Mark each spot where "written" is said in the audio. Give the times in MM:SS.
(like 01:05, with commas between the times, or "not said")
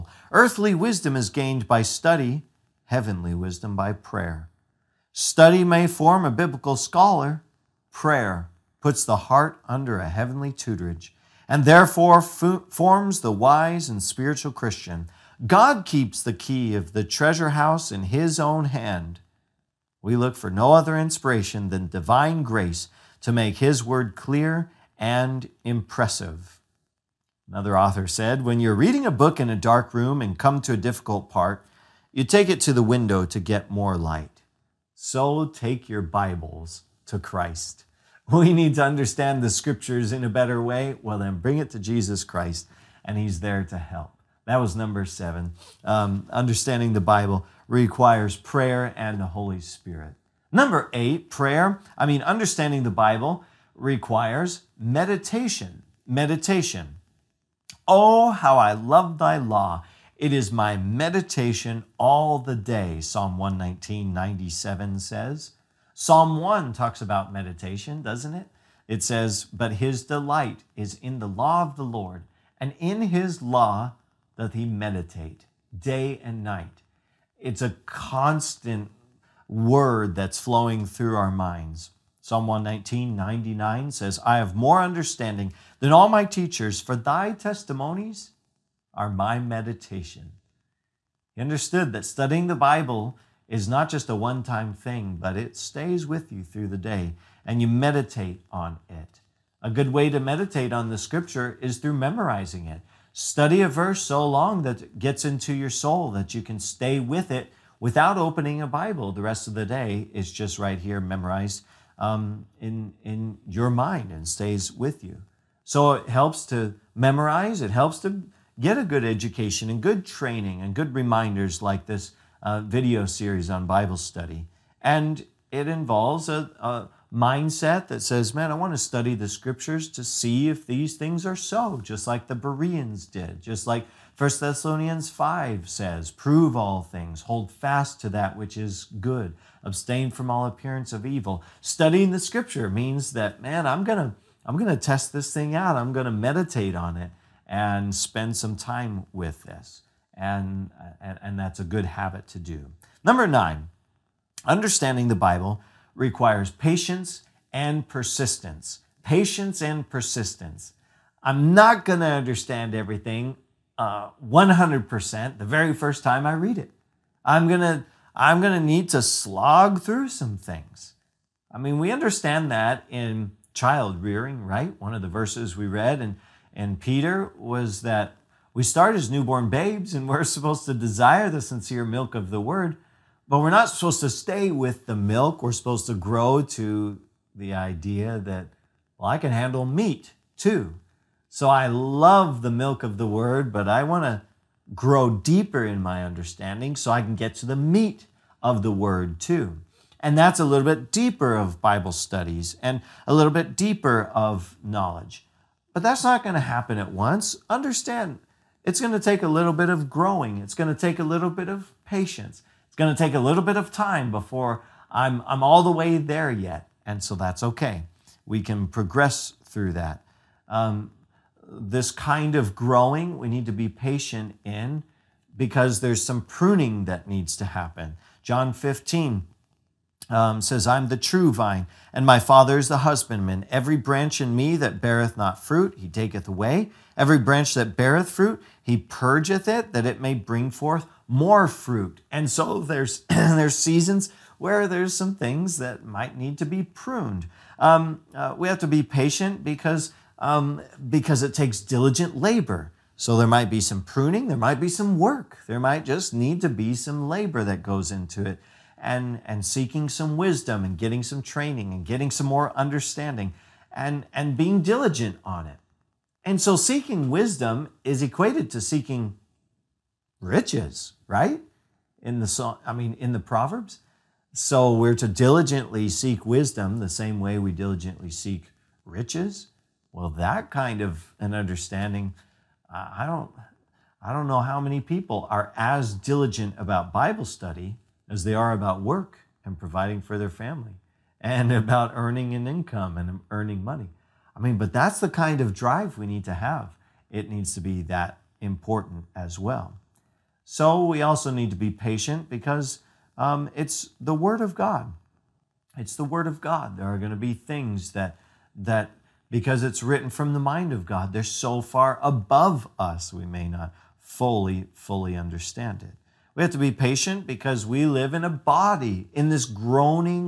05:09.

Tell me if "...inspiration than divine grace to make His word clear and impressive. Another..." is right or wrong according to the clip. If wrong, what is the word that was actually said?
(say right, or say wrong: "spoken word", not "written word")
right.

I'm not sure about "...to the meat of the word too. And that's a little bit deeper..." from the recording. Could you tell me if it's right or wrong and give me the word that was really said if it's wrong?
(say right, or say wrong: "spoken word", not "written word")
right.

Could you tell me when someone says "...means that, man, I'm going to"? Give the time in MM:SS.
02:22.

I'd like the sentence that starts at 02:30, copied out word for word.
And, and, and, that's a good habit to do.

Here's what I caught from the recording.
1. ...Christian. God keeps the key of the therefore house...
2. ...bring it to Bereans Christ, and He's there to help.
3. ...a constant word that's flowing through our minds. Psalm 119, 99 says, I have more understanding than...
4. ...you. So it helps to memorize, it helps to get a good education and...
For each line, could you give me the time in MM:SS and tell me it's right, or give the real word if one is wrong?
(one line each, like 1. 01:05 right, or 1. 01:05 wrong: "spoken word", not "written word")
1. 00:14 wrong: "treasure", not "therefore"
2. 00:41 wrong: "Jesus", not "Bereans"
3. 01:17 right
4. 01:55 right.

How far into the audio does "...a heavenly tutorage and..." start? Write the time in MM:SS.
00:09.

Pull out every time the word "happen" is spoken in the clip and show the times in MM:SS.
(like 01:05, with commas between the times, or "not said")
03:26, 03:47.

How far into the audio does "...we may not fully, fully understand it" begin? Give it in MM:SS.
05:13.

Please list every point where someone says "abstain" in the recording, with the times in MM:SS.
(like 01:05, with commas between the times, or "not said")
02:19.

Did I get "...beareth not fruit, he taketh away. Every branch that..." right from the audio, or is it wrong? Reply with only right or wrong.
right.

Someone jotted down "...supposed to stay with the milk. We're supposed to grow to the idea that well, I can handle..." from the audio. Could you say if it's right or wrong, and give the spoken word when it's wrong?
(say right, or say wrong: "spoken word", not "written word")
right.